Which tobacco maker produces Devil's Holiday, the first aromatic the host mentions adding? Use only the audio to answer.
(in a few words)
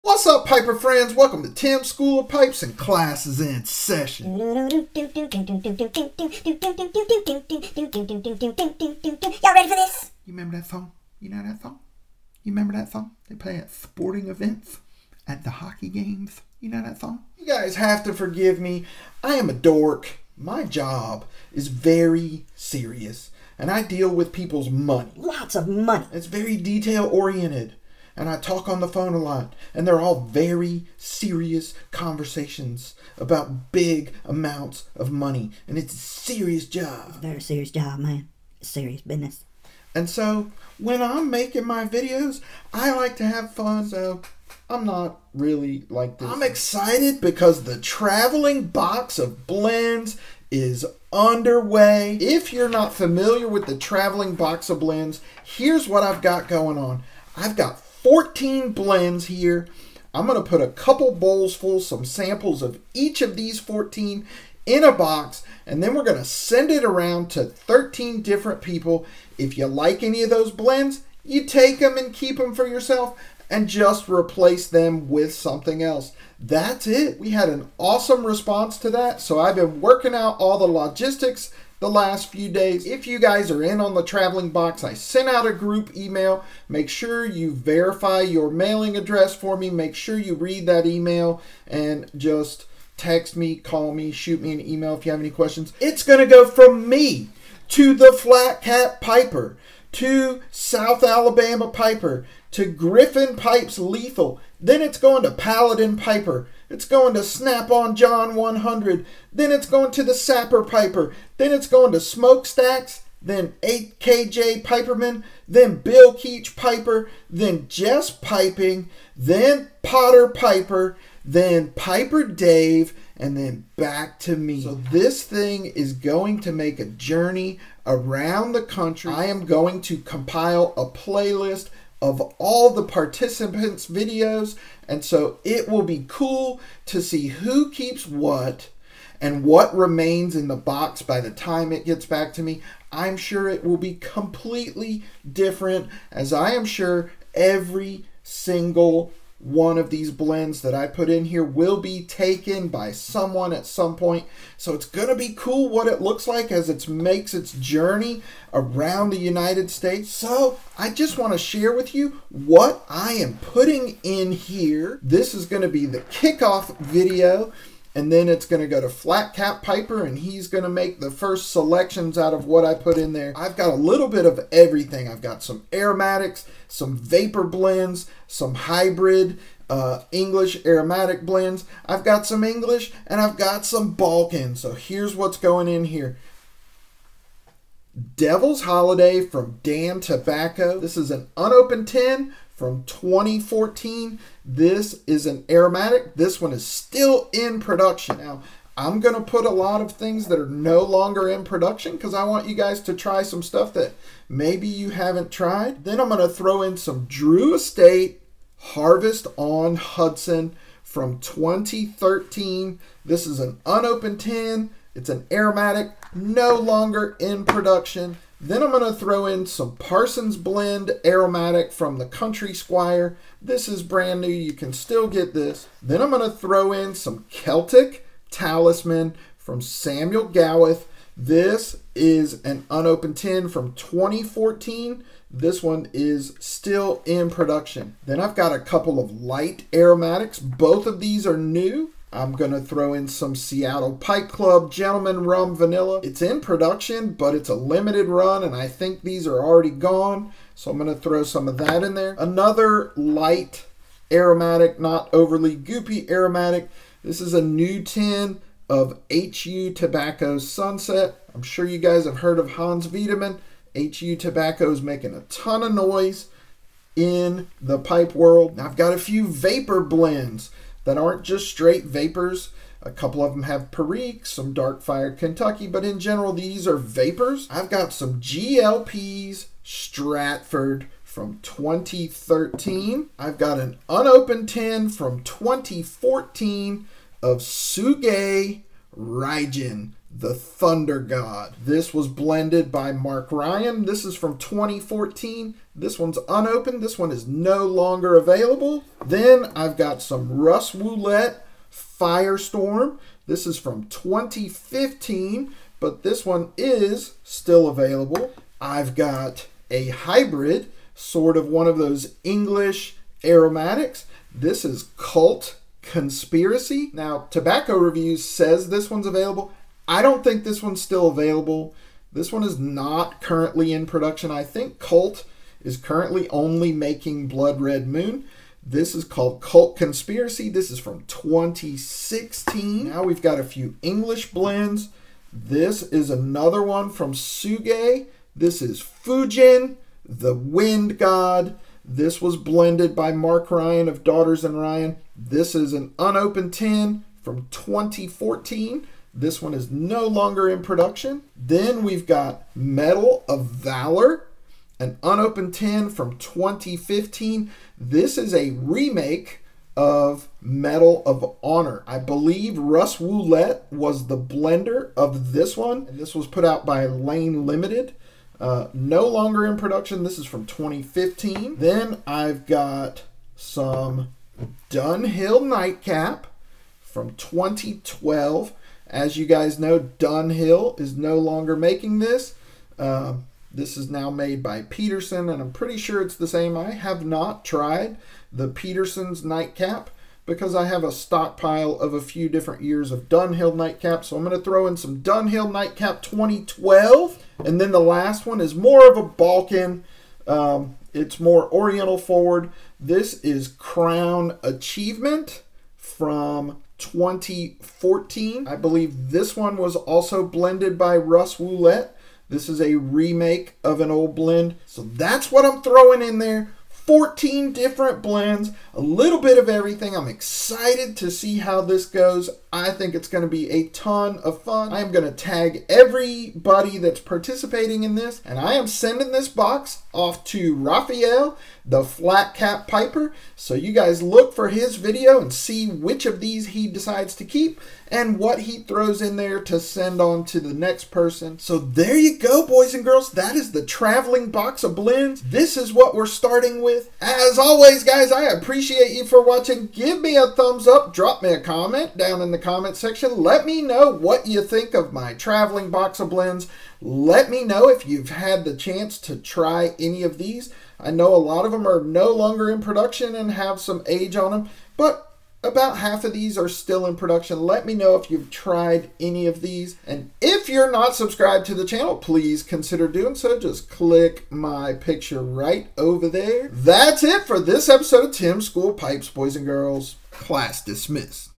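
Dan Tobacco.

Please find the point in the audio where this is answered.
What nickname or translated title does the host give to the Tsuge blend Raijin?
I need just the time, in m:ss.
4:50.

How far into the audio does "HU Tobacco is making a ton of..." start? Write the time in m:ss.
4:23.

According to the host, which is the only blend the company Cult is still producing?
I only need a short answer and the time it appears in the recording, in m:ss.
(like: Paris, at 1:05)
Blood Red Moon, at 5:27.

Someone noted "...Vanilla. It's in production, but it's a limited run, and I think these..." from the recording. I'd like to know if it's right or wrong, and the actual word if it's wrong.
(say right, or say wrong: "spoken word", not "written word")
right.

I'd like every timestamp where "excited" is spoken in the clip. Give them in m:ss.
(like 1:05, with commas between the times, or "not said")
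0:46, 7:00.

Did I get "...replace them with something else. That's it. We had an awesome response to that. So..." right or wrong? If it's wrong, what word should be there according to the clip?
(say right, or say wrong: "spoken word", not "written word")
right.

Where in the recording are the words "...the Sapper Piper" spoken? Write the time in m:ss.
1:50.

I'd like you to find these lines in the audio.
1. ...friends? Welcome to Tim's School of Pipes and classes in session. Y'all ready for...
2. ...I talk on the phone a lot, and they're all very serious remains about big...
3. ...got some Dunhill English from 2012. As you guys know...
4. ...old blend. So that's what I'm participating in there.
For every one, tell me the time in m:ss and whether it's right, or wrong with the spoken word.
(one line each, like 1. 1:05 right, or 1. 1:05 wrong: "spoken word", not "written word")
1. 0:00 right
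2. 0:28 wrong: "conversations", not "remains"
3. 6:12 wrong: "Nightcap", not "English"
4. 6:53 wrong: "throwing", not "participating".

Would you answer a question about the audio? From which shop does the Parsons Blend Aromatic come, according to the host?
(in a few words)
the Country Squire.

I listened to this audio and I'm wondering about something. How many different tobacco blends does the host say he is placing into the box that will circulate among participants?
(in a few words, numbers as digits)
14.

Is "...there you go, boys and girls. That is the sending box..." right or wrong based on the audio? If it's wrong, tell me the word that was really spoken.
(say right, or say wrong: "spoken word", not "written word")
wrong: "traveling", not "sending".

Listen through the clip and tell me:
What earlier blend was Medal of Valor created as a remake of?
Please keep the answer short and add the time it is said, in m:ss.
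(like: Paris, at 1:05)
Medal of Honor, at 6:00.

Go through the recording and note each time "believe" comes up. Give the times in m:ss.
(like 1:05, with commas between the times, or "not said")
6:01, 6:48.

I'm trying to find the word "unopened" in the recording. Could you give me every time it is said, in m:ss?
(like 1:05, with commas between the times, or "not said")
3:11, 3:33, 3:52, 4:43, 4:56, 5:45, 5:55.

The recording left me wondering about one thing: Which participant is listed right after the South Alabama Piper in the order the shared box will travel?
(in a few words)
Griffin Pipes Lethal.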